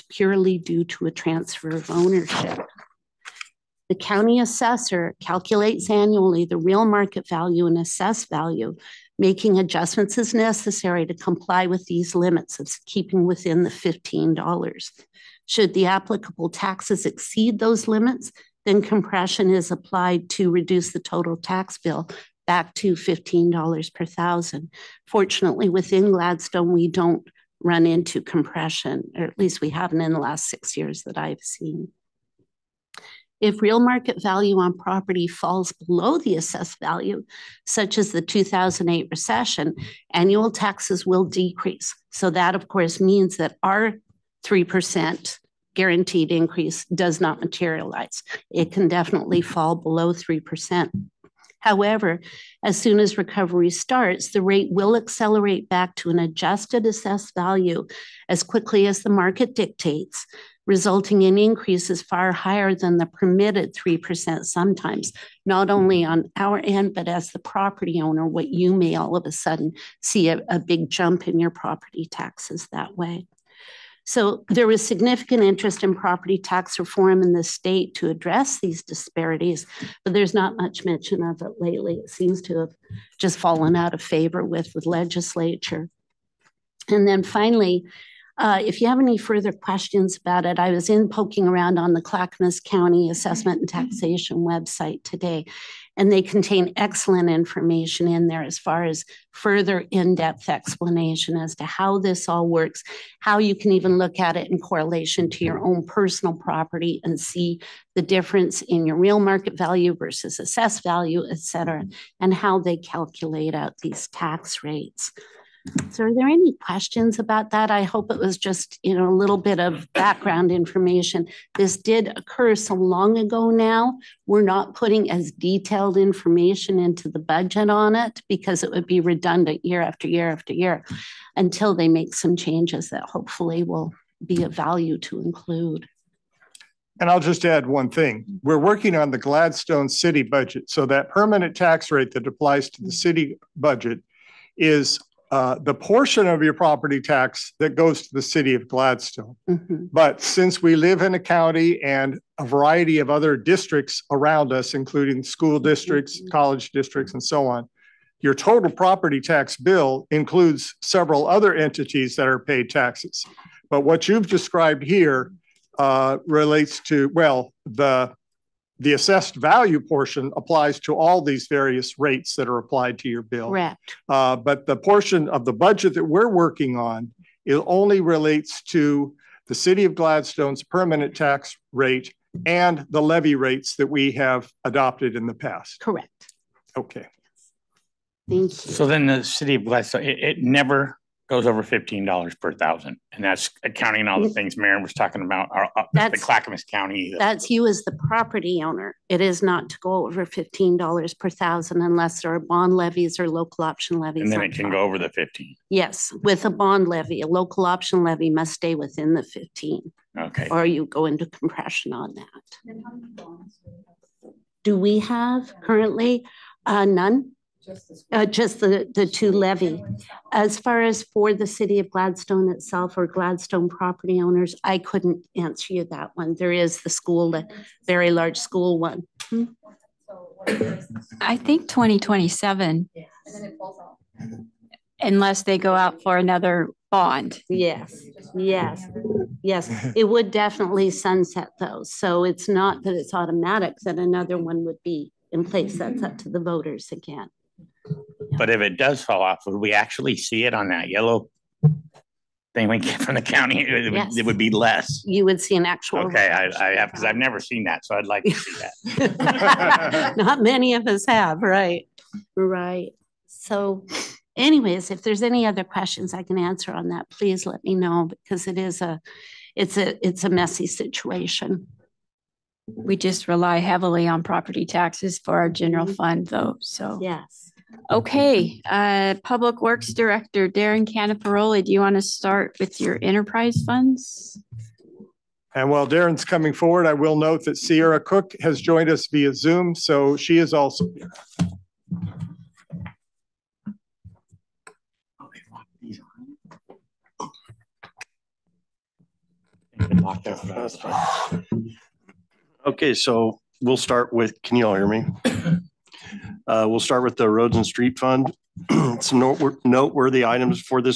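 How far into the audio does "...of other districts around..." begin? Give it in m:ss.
2:32.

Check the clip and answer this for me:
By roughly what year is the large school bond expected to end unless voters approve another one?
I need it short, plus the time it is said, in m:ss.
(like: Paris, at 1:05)
2027, at 3:51.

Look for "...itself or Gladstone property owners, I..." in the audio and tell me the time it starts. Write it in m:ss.
3:42.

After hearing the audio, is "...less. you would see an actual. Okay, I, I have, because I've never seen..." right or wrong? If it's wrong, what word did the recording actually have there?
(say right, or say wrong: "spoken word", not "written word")
right.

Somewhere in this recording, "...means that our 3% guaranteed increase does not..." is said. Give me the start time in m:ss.
0:43.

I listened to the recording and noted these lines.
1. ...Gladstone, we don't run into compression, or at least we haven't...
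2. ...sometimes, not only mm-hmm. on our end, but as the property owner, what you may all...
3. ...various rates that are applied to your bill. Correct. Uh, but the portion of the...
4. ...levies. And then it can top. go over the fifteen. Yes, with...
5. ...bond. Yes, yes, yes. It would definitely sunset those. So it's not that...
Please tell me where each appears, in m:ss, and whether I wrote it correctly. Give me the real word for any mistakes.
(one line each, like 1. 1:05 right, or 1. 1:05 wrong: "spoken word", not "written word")
1. 0:26 right
2. 1:04 right
3. 2:51 right
4. 3:23 right
5. 3:56 right.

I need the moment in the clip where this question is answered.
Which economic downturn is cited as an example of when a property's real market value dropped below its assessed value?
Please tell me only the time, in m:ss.
0:38.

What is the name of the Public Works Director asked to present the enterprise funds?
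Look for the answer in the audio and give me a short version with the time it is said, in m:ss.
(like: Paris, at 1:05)
Darren Canaparoli, at 4:40.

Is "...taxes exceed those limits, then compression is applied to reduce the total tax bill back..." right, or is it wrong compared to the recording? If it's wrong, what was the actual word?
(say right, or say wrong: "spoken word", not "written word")
right.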